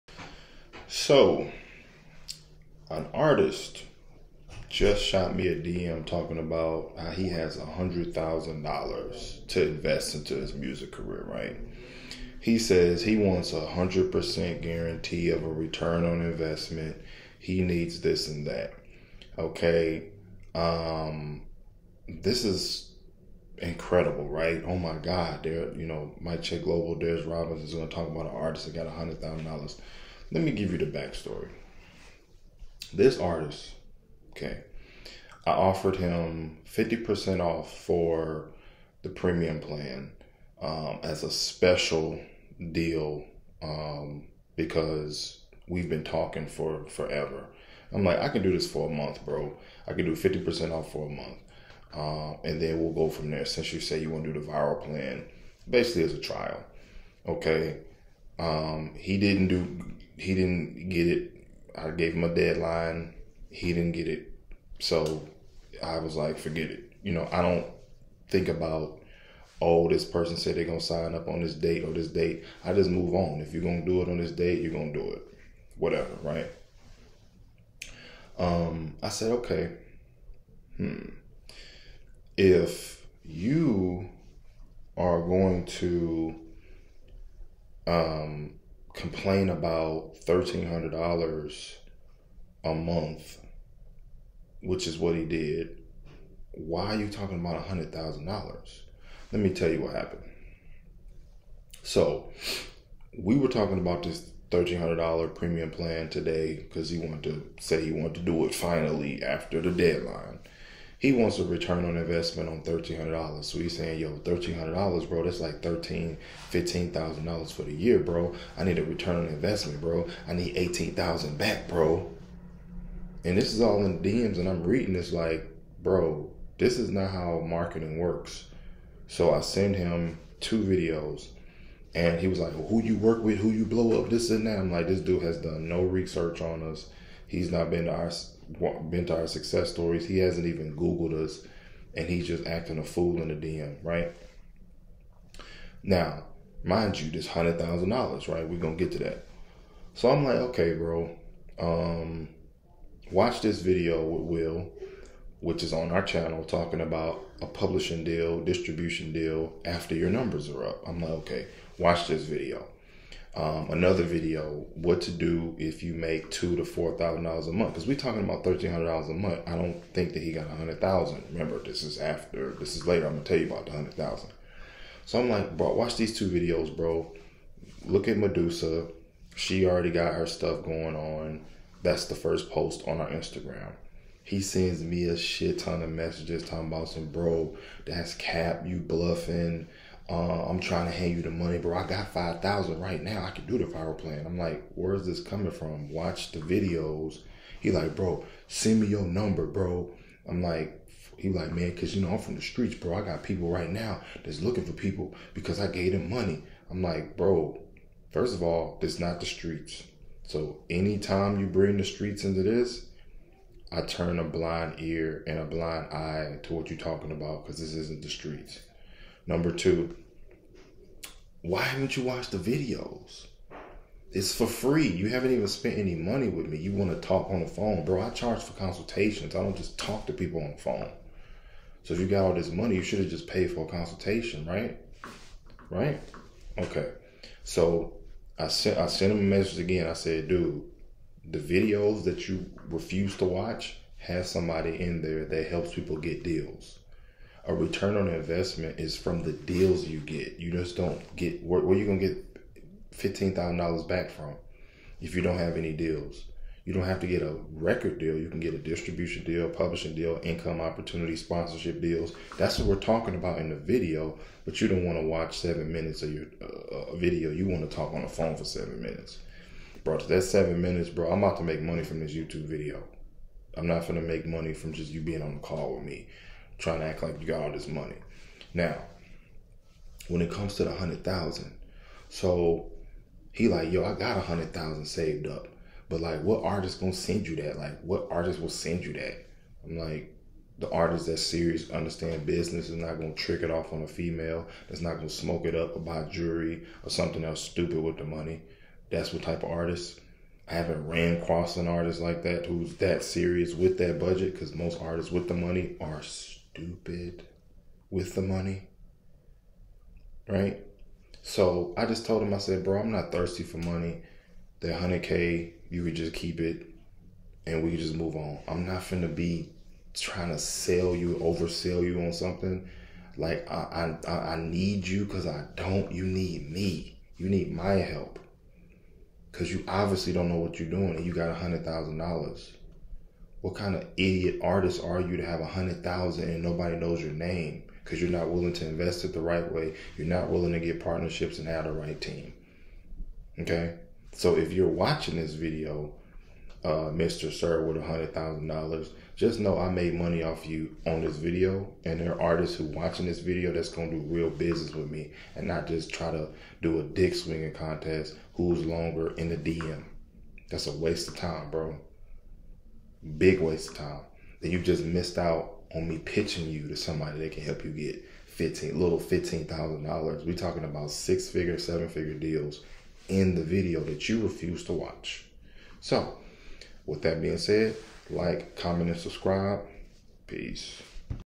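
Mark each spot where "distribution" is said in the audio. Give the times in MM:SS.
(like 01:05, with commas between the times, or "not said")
02:38, 04:18.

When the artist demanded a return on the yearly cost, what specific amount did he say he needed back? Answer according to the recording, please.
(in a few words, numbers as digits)
18,000.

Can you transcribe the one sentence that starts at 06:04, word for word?
Then you've just missed out on me pitching you to somebody that can help you get fifteen little fifteen thousand dollars.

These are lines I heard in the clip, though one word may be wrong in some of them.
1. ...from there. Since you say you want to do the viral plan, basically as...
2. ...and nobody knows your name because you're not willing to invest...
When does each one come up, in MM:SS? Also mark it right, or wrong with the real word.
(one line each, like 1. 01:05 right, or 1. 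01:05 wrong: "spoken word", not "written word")
1. 00:53 right
2. 05:36 right.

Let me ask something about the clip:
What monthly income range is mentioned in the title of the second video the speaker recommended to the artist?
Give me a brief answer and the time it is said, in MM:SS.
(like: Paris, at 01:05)
2,000 to 4,000, at 02:46.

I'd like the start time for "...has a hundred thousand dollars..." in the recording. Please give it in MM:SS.
00:07.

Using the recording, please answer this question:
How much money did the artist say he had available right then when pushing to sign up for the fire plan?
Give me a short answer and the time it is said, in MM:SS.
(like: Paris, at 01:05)
5,000, at 03:12.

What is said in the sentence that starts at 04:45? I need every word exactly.
But like what artist gonna send you that?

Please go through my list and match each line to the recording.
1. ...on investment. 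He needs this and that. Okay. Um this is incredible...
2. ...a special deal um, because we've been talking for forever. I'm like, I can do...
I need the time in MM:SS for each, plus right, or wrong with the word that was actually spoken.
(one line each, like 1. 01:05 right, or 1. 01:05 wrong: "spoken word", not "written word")
1. 00:16 right
2. 00:41 right.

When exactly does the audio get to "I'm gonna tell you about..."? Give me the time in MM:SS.
02:53.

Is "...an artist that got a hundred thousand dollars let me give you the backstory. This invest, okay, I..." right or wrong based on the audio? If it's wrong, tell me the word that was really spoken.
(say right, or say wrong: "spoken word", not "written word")
wrong: "artist", not "invest".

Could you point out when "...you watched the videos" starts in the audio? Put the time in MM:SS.
03:41.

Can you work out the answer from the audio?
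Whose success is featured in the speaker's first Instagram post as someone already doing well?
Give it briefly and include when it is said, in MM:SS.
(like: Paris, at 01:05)
Medusa, at 02:58.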